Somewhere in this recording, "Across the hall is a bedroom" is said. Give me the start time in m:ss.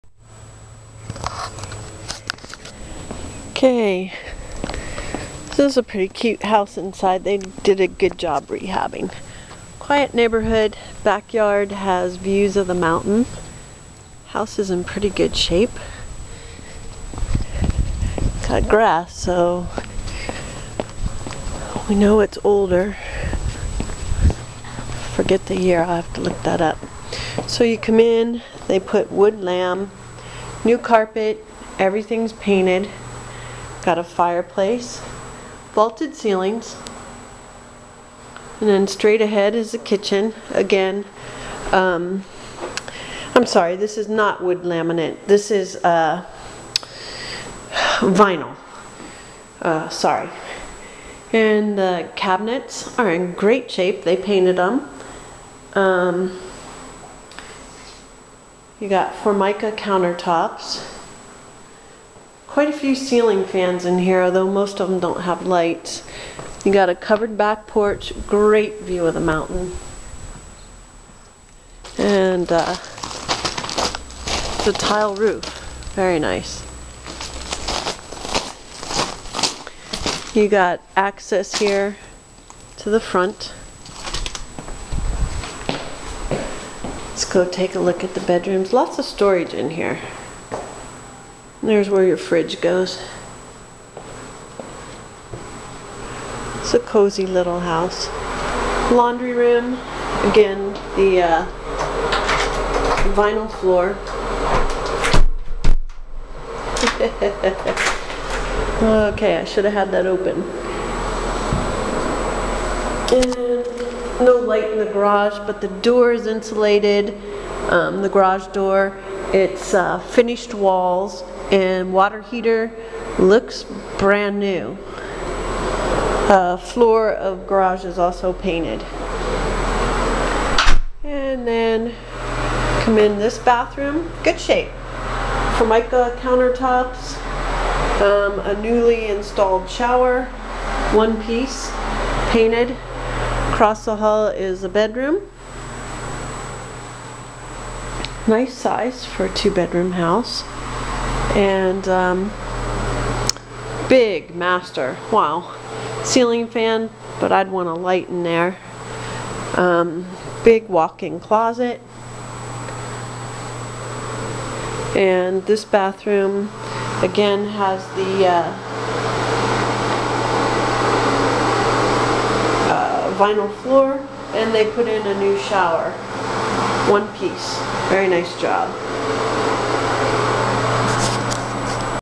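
2:23.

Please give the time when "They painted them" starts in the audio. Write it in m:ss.
0:54.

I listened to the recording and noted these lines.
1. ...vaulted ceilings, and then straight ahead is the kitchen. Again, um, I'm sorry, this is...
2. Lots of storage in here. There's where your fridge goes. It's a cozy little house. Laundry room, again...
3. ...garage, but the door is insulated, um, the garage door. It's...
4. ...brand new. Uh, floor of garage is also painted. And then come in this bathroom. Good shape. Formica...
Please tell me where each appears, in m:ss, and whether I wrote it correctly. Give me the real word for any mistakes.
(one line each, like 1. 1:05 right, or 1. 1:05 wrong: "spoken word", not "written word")
1. 0:35 right
2. 1:28 right
3. 1:54 right
4. 2:03 right.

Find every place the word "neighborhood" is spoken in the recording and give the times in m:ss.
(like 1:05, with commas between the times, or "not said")
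0:10.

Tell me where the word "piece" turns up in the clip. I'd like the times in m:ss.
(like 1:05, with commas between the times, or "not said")
2:21, 2:57.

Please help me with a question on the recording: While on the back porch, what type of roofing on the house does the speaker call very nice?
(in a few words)
tile.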